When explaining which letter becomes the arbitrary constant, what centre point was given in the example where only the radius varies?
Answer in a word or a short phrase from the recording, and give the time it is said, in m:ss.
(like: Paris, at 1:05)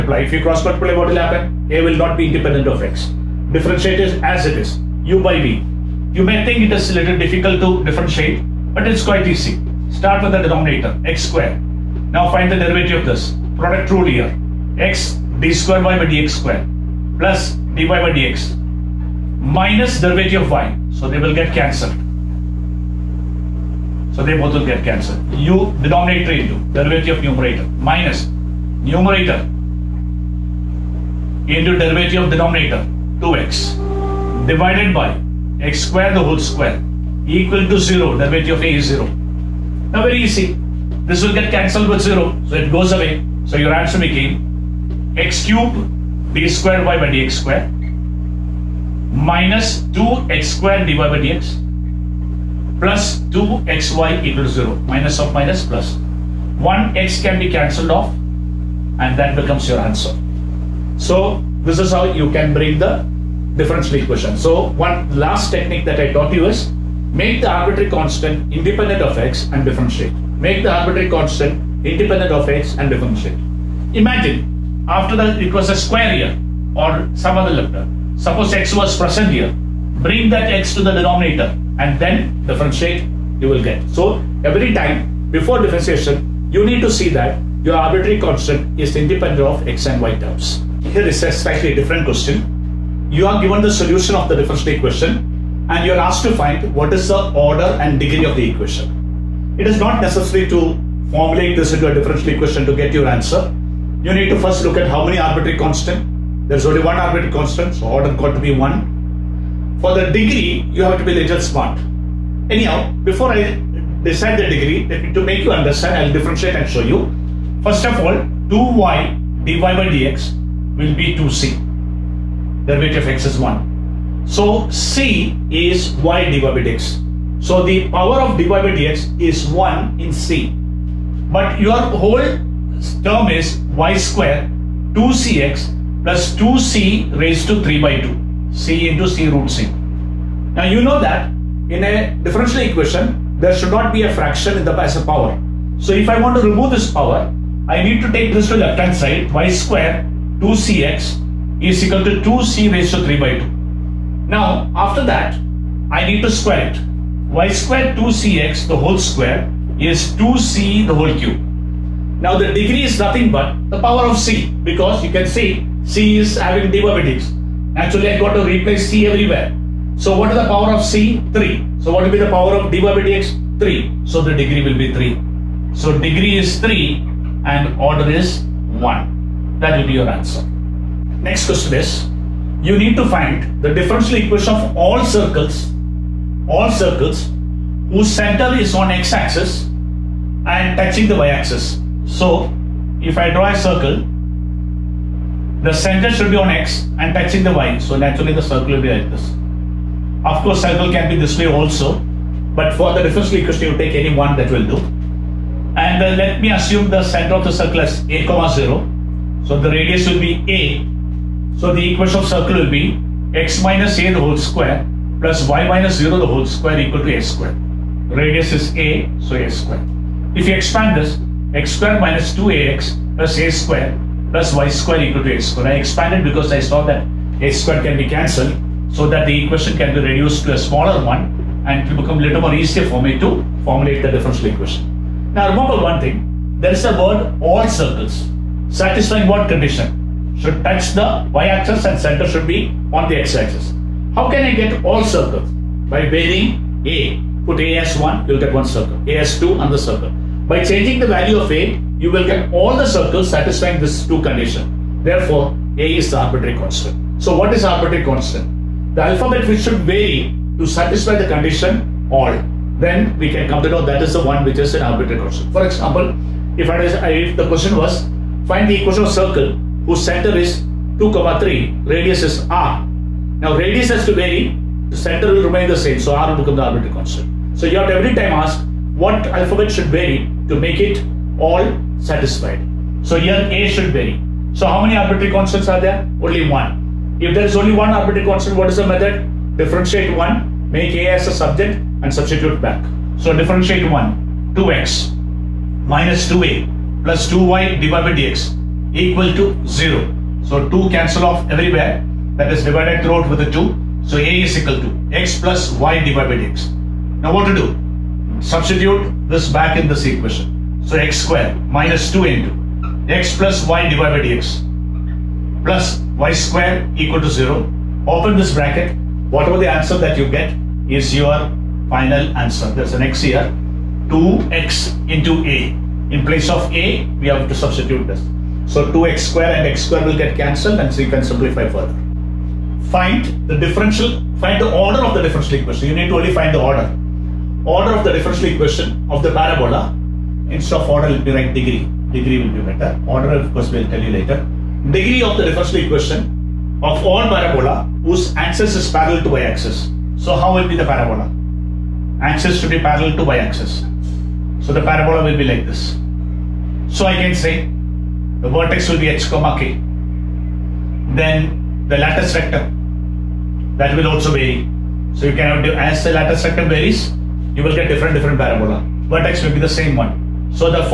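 2 comma 3, at 4:30.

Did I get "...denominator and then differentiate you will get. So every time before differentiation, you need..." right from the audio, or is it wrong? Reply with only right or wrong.
right.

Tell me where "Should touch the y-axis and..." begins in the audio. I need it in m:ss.
4:00.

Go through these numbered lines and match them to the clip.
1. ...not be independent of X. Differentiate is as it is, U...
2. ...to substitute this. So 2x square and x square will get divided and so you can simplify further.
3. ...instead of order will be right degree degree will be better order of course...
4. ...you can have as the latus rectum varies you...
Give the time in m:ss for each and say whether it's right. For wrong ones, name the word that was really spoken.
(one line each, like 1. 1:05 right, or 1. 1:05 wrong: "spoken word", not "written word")
1. 0:01 right
2. 5:27 wrong: "cancelled", not "divided"
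3. 5:40 right
4. 6:05 right.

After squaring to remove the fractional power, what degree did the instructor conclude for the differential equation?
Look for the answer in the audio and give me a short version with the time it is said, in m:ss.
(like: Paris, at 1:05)
3, at 2:54.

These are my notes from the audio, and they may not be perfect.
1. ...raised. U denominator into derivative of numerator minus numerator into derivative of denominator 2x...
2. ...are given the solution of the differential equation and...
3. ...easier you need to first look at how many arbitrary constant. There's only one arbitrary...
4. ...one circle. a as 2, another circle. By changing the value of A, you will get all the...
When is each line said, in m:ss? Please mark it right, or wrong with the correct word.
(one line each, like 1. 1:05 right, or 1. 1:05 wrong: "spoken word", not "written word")
1. 0:24 wrong: "cancelled", not "raised"
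2. 1:33 right
3. 1:43 wrong: "answer", not "easier"
4. 4:08 right.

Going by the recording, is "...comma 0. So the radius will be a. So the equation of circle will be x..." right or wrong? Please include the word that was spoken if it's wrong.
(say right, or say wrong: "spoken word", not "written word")
right.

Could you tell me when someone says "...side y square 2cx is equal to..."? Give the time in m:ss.
2:28.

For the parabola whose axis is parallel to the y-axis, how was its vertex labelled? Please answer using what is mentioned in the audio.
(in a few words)
h comma k.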